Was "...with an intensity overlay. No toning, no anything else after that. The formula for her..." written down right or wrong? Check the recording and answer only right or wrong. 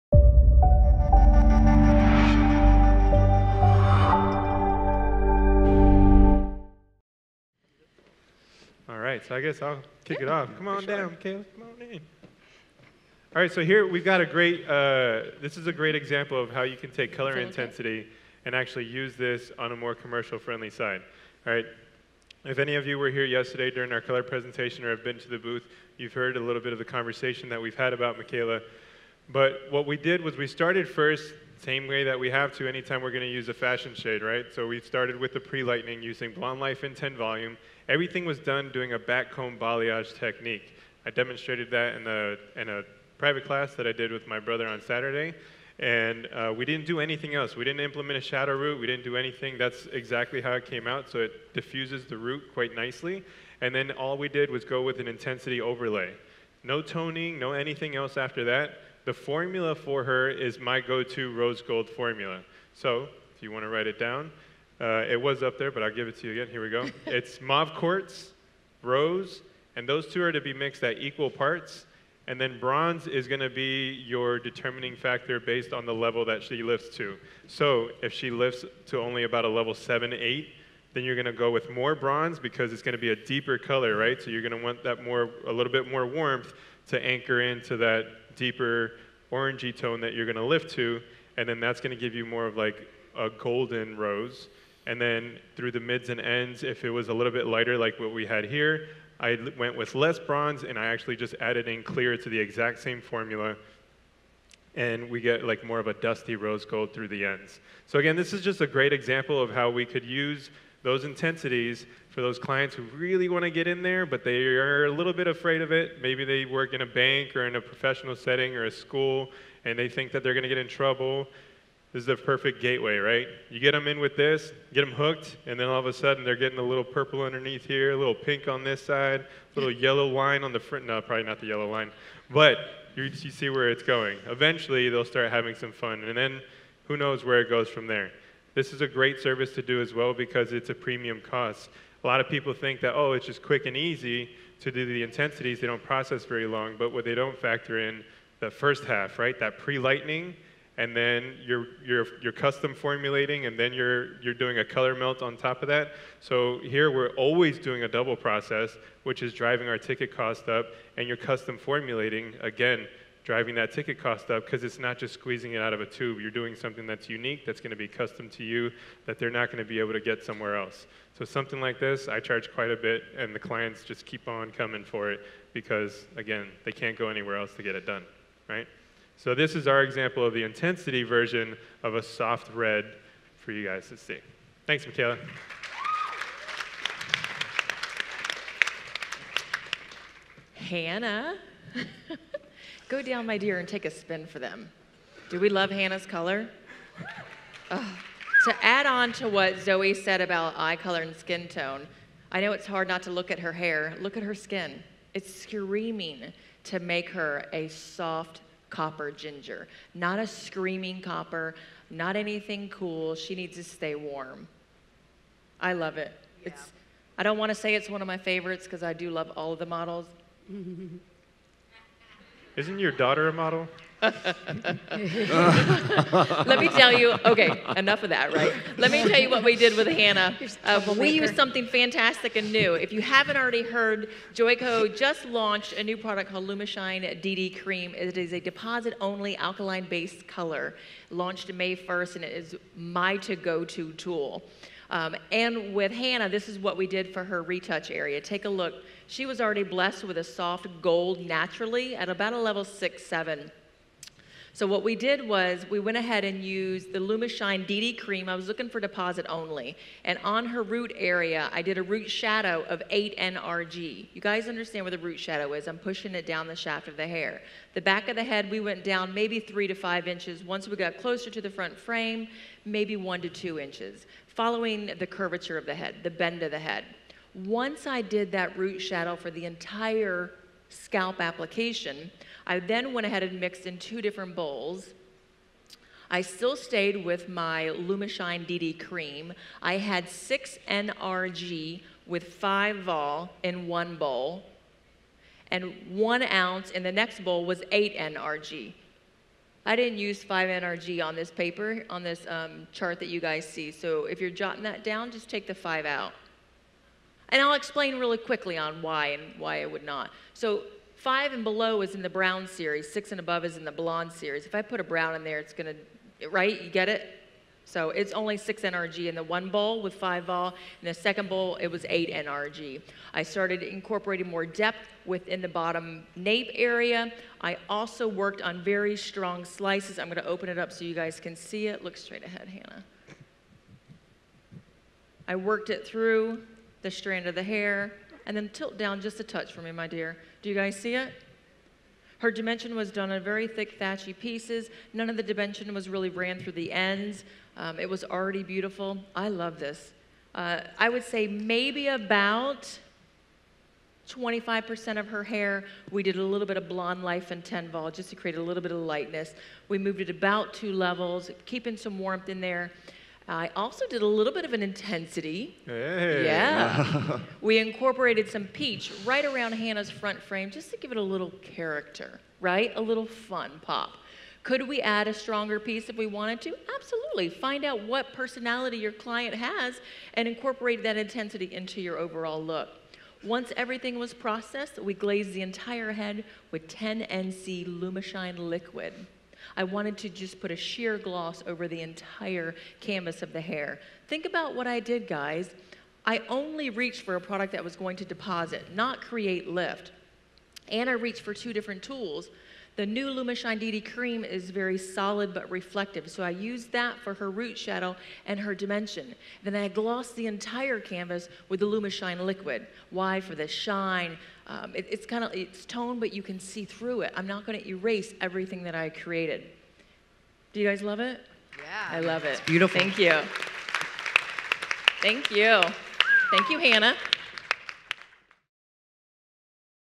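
right.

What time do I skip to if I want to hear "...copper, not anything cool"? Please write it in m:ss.
3:31.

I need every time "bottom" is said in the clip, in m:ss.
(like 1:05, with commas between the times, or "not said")
5:25.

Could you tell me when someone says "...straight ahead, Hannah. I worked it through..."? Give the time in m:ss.
5:31.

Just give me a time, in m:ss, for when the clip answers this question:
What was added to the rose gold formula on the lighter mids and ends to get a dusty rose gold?
1:41.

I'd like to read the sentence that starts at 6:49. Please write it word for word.
Then I glossed the entire canvas with the Lumishine liquid.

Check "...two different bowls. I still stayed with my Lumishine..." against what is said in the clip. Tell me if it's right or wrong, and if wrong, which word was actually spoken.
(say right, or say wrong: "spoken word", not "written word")
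right.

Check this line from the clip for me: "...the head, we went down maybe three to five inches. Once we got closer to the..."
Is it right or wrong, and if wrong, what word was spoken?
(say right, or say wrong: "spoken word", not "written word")
right.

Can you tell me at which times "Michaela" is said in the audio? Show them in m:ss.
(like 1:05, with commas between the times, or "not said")
0:28, 3:04.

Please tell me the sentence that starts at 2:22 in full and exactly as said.
A lot of people think that, oh, it's just quick and easy to do the intensities.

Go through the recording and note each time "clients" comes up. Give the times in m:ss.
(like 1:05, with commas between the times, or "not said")
1:52, 2:53, 6:18.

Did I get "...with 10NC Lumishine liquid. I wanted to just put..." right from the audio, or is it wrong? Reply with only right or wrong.
right.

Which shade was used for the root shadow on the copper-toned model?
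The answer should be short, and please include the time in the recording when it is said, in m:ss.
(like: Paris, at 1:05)
8NRG, at 4:22.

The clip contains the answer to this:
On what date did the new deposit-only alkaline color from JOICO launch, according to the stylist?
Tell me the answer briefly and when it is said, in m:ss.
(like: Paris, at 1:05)
May 1st, at 4:01.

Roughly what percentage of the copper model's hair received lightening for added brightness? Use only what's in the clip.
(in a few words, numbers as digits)
25%.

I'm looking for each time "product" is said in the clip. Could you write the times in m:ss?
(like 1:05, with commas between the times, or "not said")
3:55, 6:37.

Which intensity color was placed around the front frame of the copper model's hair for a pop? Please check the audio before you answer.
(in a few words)
peach.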